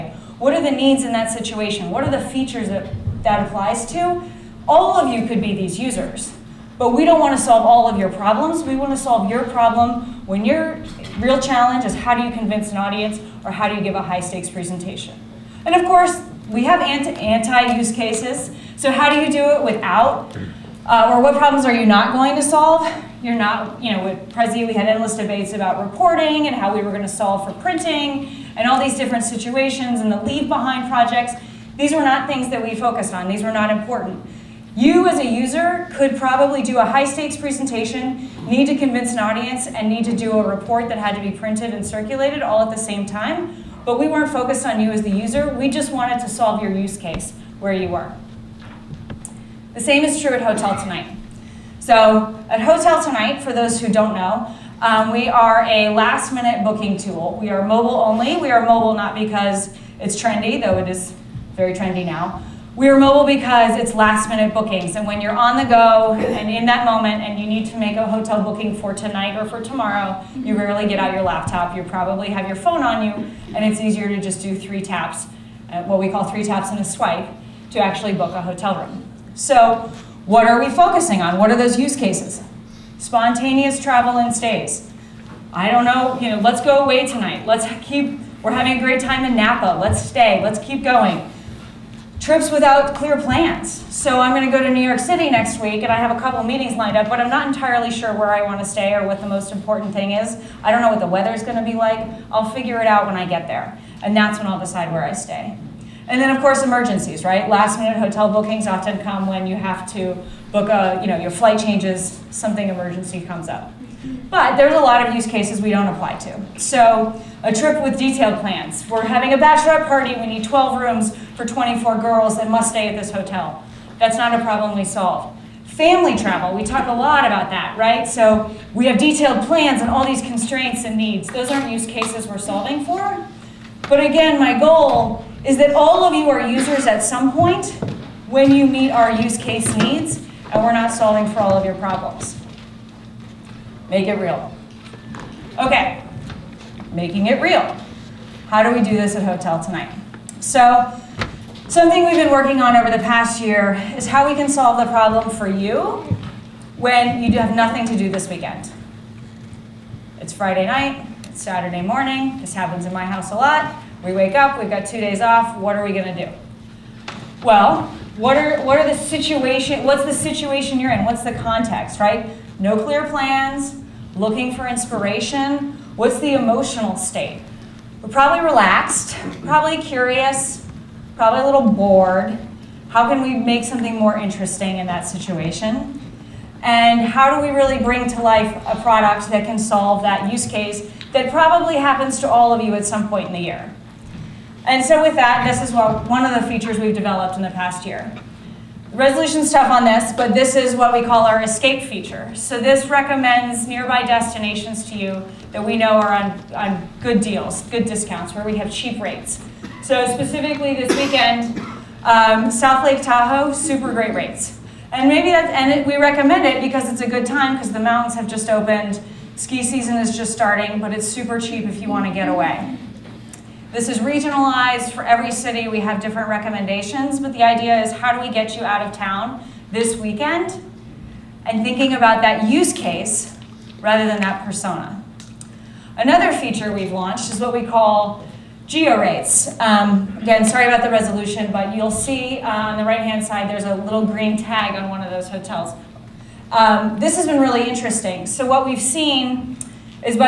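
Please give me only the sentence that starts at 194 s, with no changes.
And so with that, this is what, one of the features we've developed in the past year.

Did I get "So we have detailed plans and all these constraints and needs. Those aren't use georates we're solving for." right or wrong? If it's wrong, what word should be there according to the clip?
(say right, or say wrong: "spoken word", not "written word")
wrong: "cases", not "georates".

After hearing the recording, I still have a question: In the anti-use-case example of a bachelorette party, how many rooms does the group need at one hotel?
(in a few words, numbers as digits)
12.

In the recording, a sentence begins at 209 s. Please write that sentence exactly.
So specifically this weekend, um, South Lake Tahoe, super great rates.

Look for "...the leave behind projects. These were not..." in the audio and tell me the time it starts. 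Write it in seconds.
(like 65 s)
30 s.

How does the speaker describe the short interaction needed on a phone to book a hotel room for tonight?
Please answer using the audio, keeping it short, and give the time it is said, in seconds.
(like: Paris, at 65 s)
three taps and a swipe, at 76 s.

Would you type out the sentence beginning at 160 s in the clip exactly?
It's Friday night, it's Saturday morning, this happens in my house a lot.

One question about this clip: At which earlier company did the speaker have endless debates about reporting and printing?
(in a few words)
Prezi.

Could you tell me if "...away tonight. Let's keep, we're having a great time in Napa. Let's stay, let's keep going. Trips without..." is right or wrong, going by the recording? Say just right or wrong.
right.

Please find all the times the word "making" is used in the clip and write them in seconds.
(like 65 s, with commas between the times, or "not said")
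146 s.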